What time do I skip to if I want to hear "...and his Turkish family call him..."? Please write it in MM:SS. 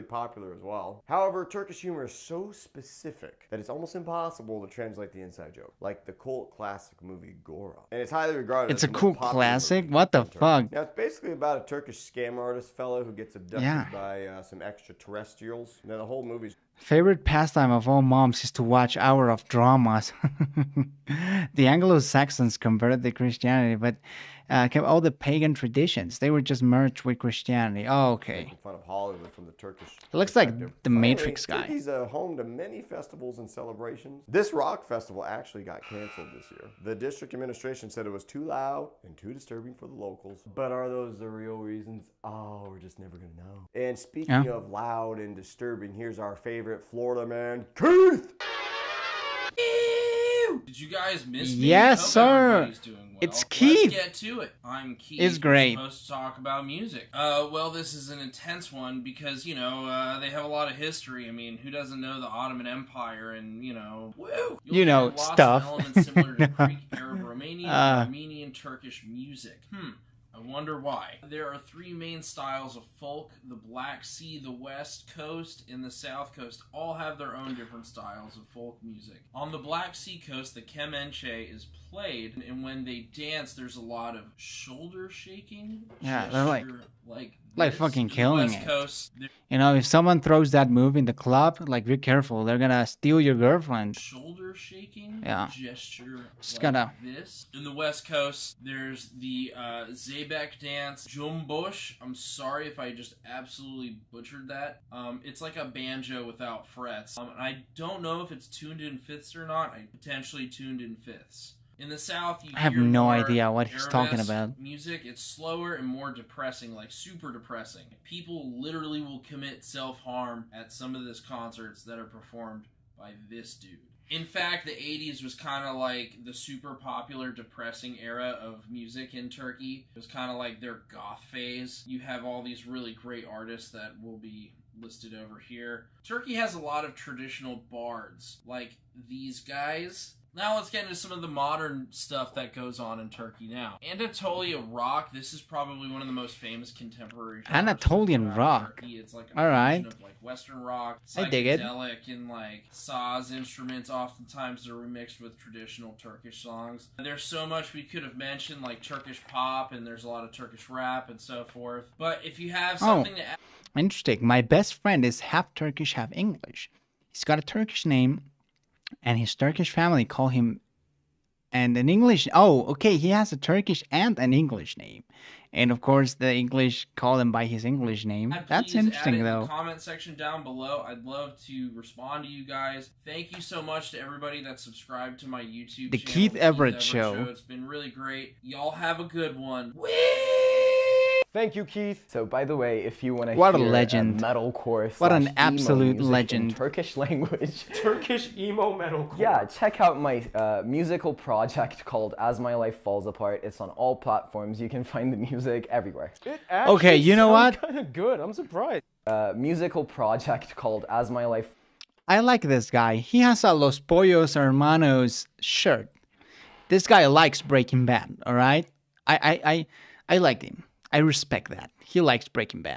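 02:49.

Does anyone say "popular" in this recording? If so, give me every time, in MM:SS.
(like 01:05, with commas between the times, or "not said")
00:00, 02:06.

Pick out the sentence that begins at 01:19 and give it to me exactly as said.
On the Black Sea coast, the Kemenche is played, and when they dance, there's a lot of shoulder shaking.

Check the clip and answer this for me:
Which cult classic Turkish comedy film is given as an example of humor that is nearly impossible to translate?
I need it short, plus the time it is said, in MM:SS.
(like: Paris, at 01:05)
Gora, at 00:07.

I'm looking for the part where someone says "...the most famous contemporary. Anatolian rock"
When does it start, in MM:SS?
02:26.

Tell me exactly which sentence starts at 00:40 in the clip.
But are those the real reasons?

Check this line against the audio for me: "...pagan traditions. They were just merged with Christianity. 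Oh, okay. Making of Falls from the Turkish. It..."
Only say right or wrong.
wrong.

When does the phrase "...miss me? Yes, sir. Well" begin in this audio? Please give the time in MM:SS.
00:51.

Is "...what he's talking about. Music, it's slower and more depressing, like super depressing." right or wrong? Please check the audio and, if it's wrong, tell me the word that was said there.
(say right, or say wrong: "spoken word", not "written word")
right.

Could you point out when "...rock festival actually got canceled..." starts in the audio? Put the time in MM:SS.
00:34.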